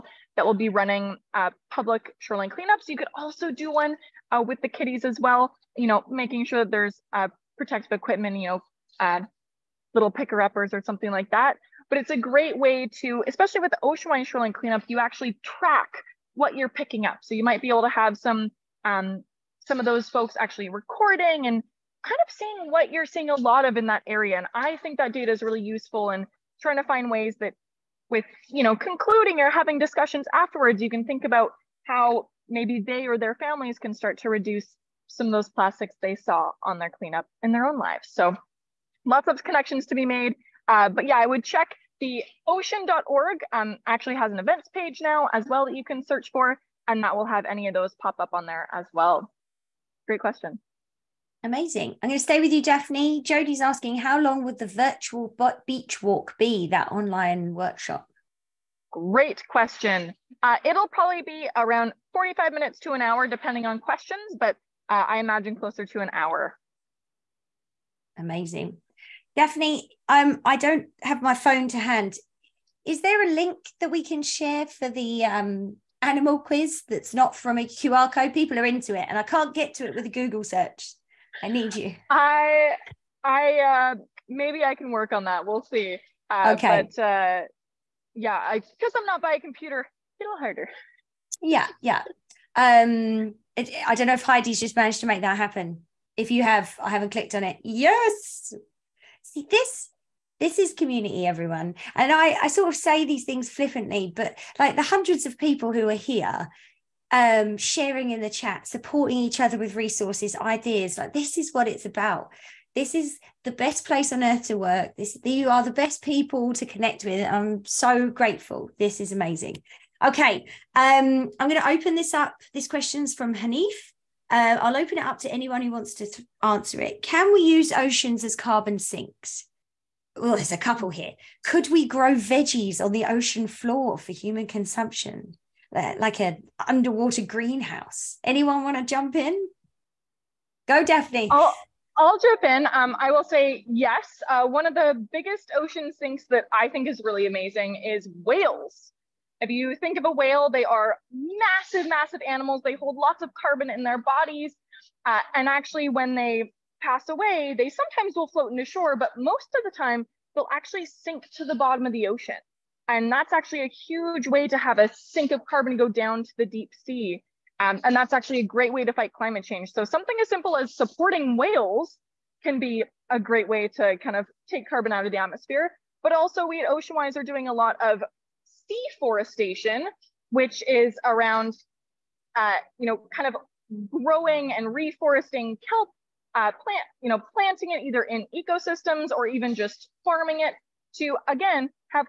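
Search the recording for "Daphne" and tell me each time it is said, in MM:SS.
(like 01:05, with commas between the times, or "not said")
00:52, 01:09, 02:20.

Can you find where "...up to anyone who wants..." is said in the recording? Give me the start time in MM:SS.
02:05.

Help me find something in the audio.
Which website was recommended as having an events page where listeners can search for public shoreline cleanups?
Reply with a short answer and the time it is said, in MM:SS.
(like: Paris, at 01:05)
ocean.org, at 00:42.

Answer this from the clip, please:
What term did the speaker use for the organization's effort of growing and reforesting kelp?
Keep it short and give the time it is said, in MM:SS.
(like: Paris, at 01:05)
seaforestation, at 02:58.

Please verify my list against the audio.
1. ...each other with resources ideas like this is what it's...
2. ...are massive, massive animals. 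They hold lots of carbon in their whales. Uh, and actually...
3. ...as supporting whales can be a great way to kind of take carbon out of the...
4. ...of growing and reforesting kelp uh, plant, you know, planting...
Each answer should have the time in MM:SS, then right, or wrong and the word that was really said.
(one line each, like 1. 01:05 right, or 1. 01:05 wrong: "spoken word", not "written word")
1. 01:49 right
2. 02:30 wrong: "bodies", not "whales"
3. 02:50 right
4. 03:03 right.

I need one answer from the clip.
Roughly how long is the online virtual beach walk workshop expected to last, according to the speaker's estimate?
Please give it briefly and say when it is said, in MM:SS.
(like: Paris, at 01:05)
45 minutes to an hour, at 01:02.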